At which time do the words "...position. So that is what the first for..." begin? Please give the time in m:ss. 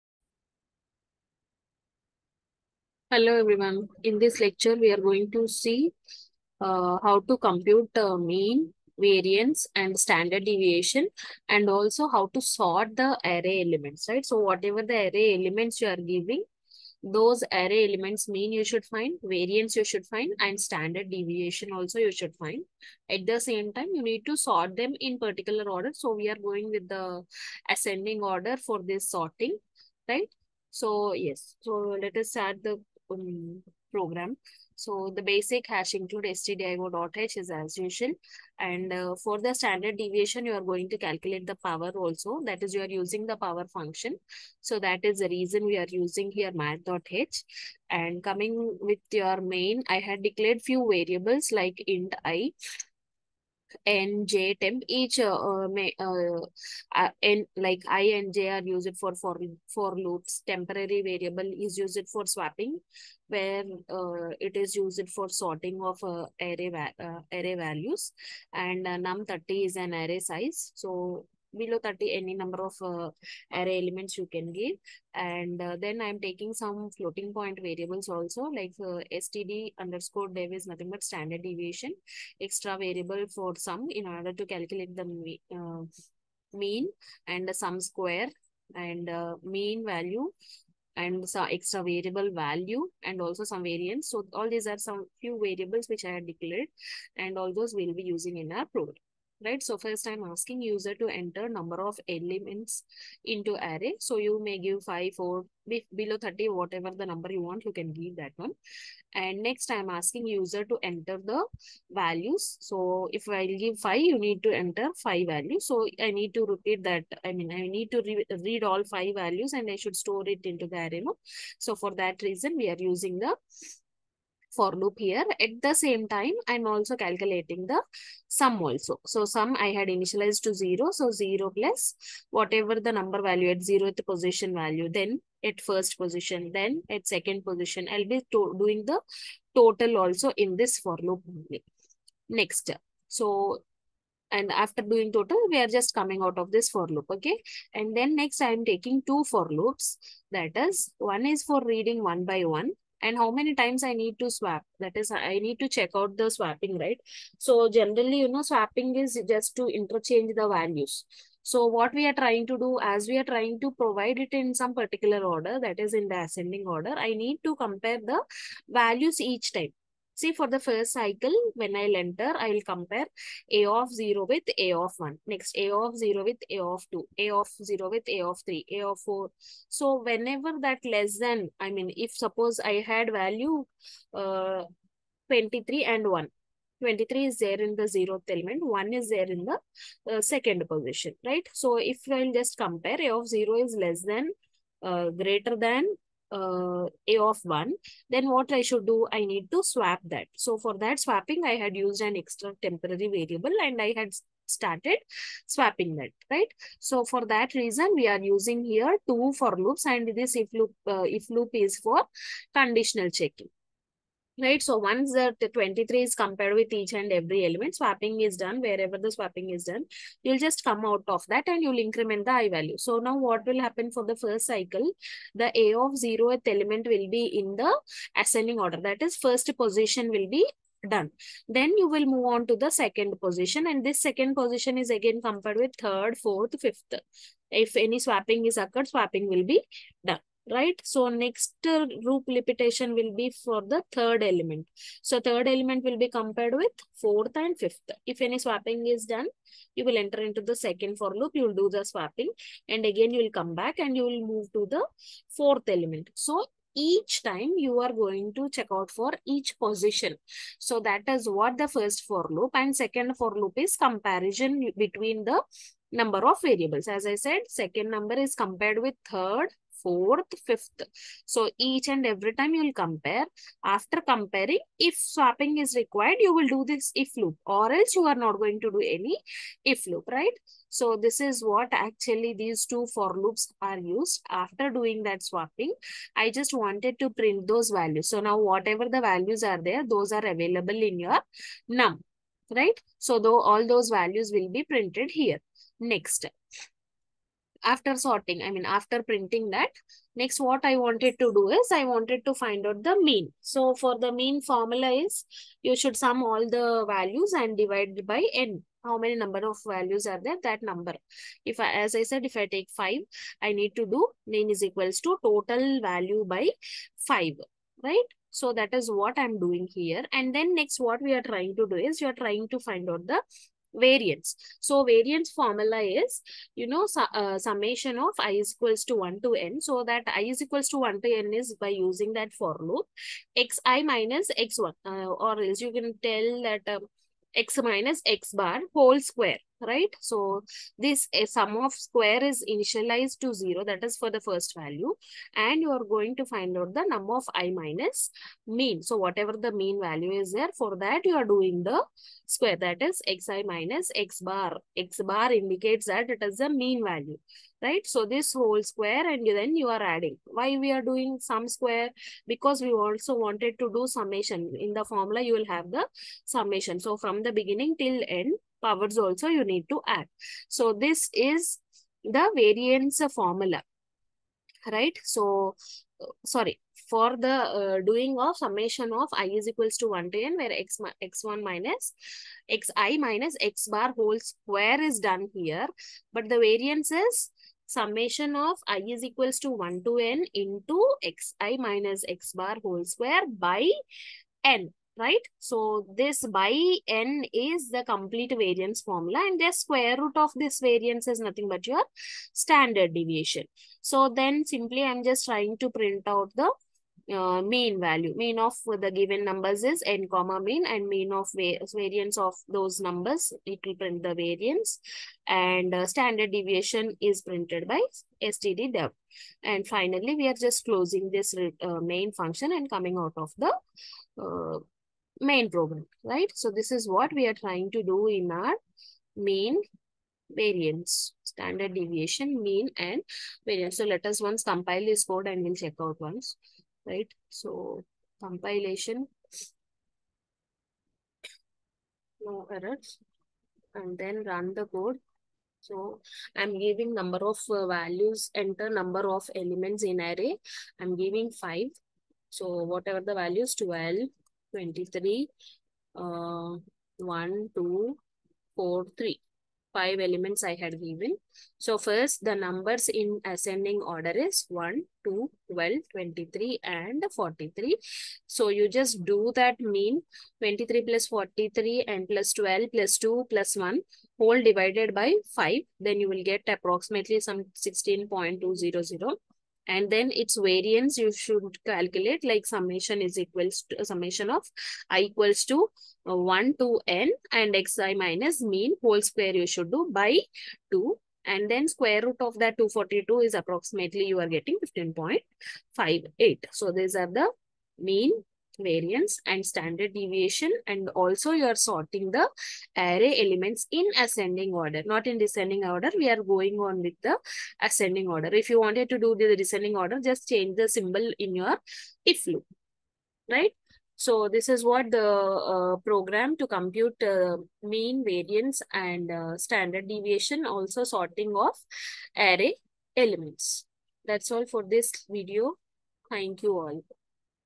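4:19.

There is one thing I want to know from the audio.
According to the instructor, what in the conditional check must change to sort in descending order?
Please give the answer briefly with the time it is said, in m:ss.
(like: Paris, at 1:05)
the symbol, at 8:30.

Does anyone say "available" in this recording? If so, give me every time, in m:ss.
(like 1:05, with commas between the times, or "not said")
4:50.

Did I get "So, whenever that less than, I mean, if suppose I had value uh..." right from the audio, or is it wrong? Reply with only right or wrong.
right.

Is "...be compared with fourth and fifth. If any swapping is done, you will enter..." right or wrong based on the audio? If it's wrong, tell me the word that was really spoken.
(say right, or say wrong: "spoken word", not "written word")
right.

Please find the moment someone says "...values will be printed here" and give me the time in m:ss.
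4:53.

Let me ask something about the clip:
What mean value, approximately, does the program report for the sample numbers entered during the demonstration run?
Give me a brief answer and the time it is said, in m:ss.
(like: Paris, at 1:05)
16.2, at 7:57.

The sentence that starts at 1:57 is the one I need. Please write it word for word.
I mean, I need to re read all 5 values and I should store it into the array.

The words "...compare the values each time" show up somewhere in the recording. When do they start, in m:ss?
2:47.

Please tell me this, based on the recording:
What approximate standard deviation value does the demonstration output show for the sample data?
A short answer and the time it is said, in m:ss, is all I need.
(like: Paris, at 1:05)
15.58, at 8:14.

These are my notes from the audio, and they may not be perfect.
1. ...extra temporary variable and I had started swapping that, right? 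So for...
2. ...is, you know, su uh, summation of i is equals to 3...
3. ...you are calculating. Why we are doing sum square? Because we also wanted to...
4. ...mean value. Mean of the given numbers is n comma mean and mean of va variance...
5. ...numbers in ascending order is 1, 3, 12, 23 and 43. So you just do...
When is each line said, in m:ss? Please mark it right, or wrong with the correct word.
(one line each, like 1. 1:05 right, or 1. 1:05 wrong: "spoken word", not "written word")
1. 3:22 right
2. 5:25 wrong: "1", not "3"
3. 5:59 wrong: "adding", not "calculating"
4. 6:47 right
5. 7:42 wrong: "2", not "3".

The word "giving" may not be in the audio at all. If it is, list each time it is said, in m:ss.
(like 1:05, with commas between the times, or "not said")
0:15, 7:26, 7:30.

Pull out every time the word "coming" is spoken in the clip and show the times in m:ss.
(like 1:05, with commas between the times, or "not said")
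0:48, 2:25, 7:02.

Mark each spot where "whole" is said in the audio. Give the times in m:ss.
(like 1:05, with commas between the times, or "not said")
5:38, 5:58, 6:23, 6:32, 7:54, 8:08.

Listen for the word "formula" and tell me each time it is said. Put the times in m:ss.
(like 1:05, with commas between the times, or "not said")
5:04, 5:25, 6:04, 6:13, 6:38.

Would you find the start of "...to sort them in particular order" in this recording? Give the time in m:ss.
0:24.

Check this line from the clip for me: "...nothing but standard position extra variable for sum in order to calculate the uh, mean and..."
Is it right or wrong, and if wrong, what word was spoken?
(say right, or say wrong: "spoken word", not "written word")
wrong: "deviation", not "position".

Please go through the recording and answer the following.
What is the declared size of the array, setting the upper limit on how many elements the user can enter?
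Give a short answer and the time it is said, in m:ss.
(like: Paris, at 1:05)
30, at 1:09.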